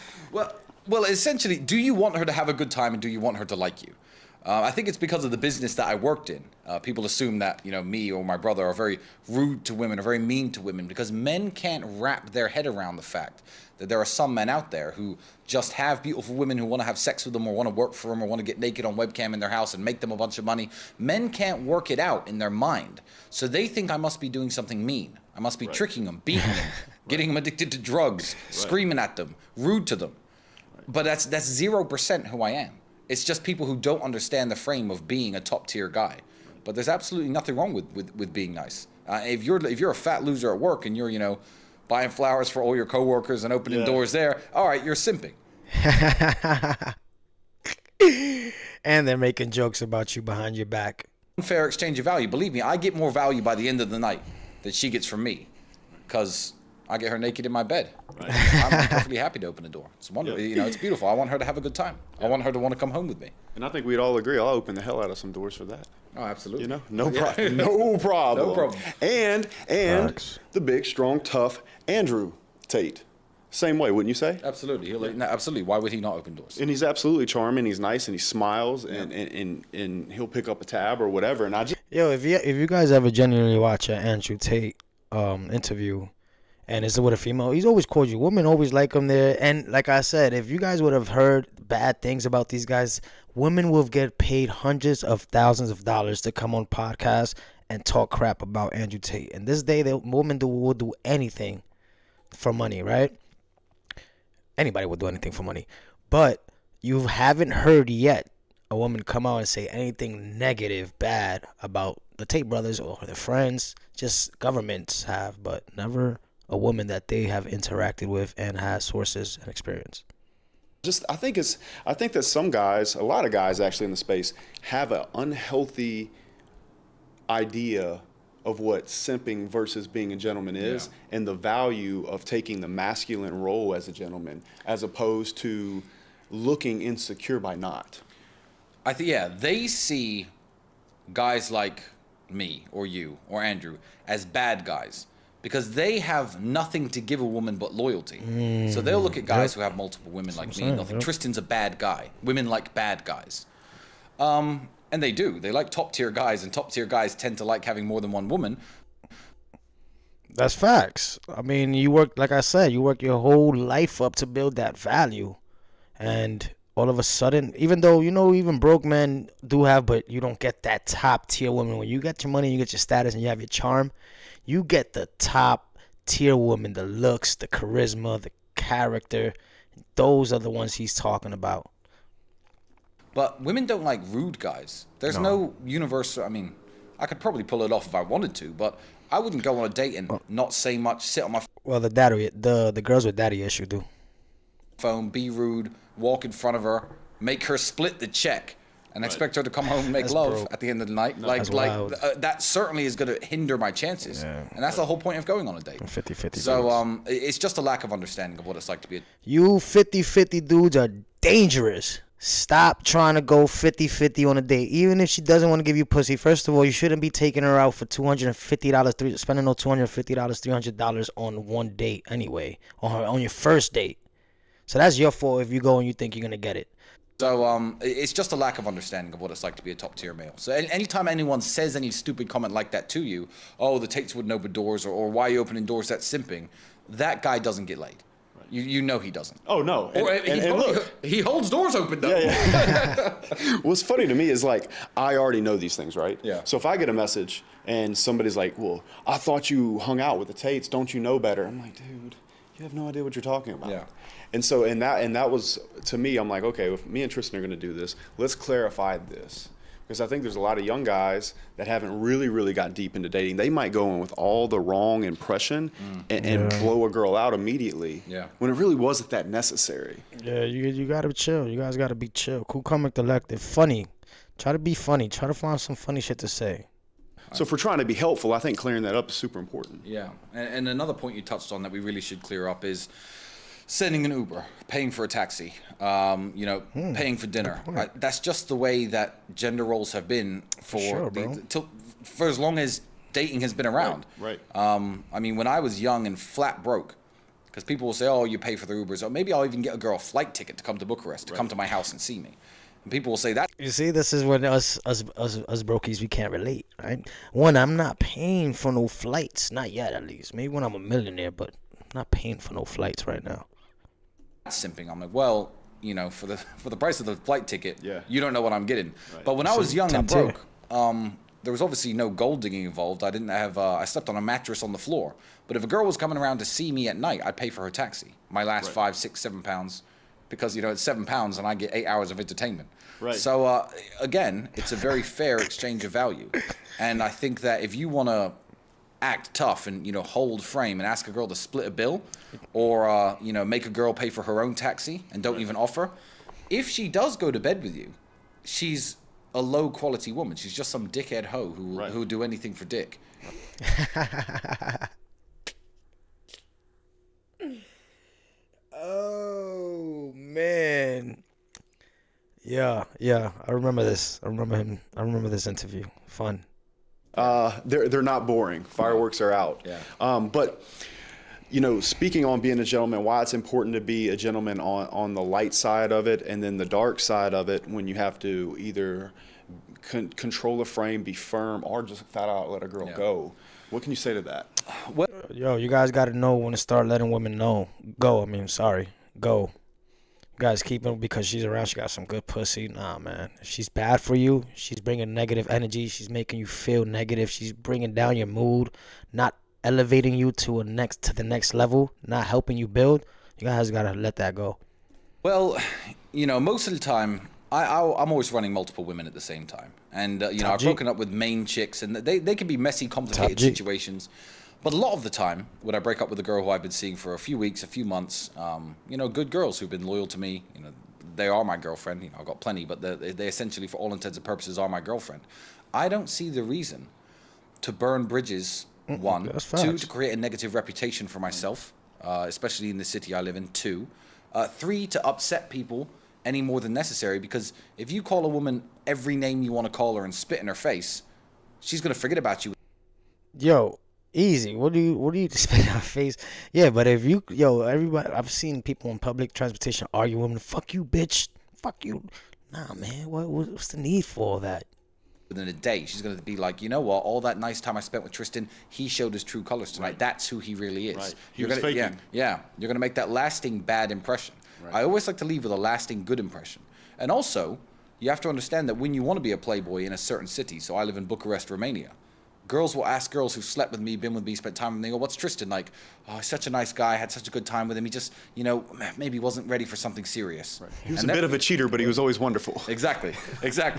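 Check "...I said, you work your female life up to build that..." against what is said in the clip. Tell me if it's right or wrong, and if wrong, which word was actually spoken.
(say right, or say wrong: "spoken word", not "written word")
wrong: "whole", not "female".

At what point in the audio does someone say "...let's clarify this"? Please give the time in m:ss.
4:18.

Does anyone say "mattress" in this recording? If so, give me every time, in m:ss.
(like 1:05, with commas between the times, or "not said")
5:24.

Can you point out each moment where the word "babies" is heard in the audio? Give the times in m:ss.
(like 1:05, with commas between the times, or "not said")
not said.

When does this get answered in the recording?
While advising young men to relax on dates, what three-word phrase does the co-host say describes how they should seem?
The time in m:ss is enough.
4:32.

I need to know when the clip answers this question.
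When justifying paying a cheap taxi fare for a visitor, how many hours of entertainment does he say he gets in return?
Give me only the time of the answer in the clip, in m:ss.
5:31.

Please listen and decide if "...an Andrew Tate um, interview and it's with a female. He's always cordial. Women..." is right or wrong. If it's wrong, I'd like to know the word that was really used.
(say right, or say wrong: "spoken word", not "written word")
right.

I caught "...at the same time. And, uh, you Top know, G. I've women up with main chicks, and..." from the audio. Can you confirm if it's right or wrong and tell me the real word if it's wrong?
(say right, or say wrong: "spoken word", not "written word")
wrong: "broken", not "women".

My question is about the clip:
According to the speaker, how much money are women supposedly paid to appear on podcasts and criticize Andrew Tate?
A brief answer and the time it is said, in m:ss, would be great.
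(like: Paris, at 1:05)
Hundreds of thousands of dollars, at 1:34.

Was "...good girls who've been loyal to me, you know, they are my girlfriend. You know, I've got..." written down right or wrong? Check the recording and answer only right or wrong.
right.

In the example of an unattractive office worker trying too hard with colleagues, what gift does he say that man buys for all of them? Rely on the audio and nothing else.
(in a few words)
Flowers.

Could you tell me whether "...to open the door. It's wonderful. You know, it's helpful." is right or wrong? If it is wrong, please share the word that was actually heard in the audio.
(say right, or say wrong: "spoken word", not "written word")
wrong: "beautiful", not "helpful".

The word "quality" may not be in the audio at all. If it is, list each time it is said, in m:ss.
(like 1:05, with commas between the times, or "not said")
5:49.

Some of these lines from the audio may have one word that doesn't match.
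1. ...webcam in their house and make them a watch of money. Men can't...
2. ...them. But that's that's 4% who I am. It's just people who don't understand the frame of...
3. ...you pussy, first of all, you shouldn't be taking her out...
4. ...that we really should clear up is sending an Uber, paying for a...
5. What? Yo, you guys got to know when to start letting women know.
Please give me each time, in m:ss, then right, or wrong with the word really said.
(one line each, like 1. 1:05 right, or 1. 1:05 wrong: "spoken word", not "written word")
1. 0:18 wrong: "bunch", not "watch"
2. 0:29 wrong: "0", not "4"
3. 3:35 right
4. 4:41 right
5. 6:24 right.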